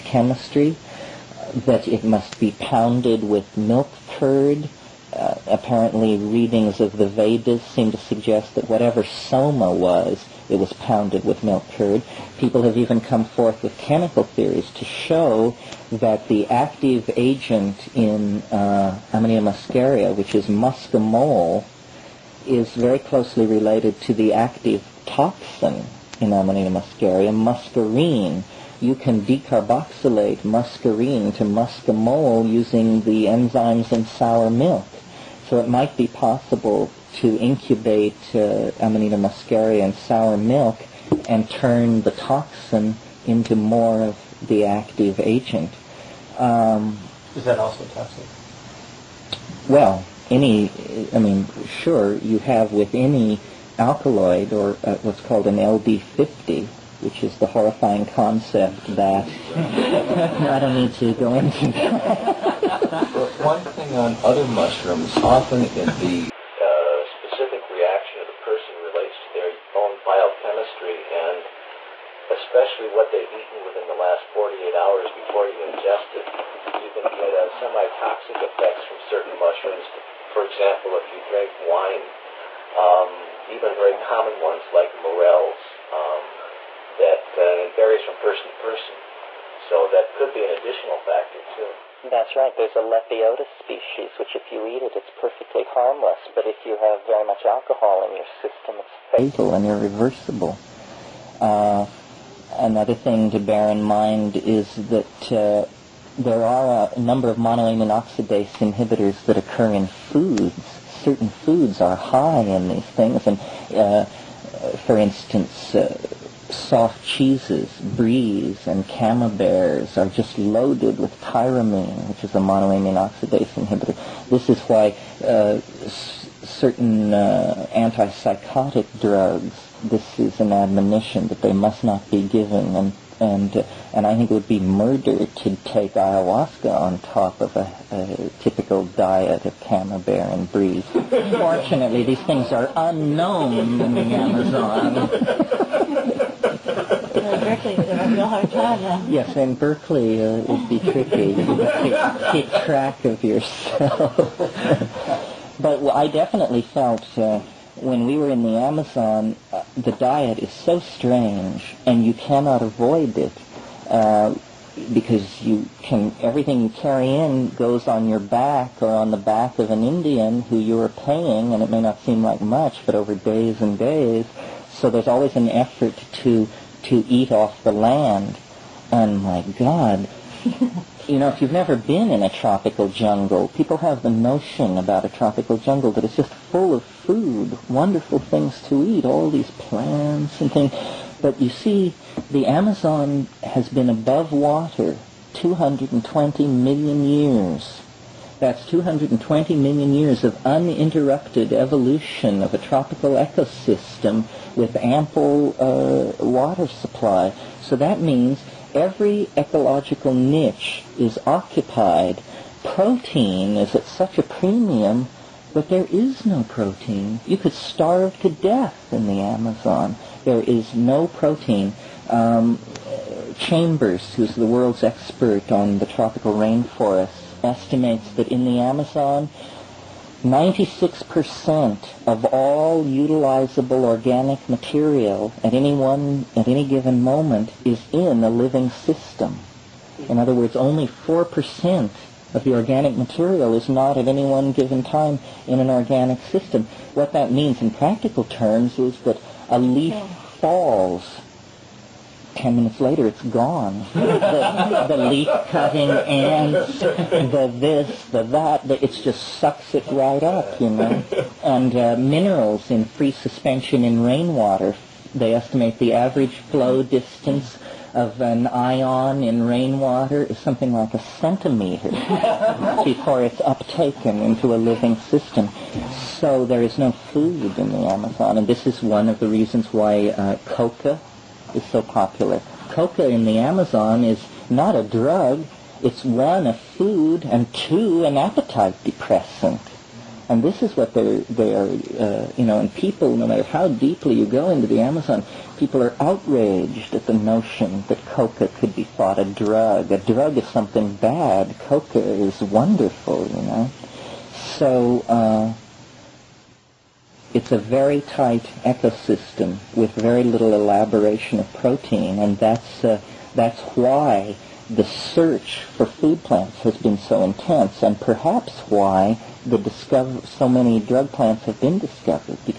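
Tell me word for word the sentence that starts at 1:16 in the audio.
You can get uh, semi-toxic effects from certain mushrooms.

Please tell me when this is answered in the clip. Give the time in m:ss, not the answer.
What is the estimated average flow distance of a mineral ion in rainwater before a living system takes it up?
4:30.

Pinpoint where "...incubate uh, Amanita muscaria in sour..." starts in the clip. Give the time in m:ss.
0:37.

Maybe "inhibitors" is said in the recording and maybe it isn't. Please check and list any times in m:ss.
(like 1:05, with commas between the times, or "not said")
1:48, 2:03.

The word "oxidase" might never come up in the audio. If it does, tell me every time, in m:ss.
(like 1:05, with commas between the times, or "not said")
1:47, 2:03.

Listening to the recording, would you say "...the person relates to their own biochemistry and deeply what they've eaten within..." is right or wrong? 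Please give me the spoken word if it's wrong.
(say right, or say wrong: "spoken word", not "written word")
wrong: "especially", not "deeply".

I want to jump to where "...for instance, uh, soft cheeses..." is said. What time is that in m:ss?
1:54.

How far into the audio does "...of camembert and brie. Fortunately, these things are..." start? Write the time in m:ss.
2:19.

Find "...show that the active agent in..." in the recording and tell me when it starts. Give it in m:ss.
0:14.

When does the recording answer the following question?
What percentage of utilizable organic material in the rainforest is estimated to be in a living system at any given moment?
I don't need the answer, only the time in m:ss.
3:50.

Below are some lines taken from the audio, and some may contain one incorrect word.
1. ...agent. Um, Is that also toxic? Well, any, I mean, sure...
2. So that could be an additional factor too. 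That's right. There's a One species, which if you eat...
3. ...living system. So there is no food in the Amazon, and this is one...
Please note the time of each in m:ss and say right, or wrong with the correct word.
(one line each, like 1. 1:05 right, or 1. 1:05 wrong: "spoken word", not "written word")
1. 0:45 right
2. 1:29 wrong: "Lepiota", not "One"
3. 4:34 right.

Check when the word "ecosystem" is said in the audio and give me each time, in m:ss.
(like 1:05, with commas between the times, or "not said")
3:23, 5:08.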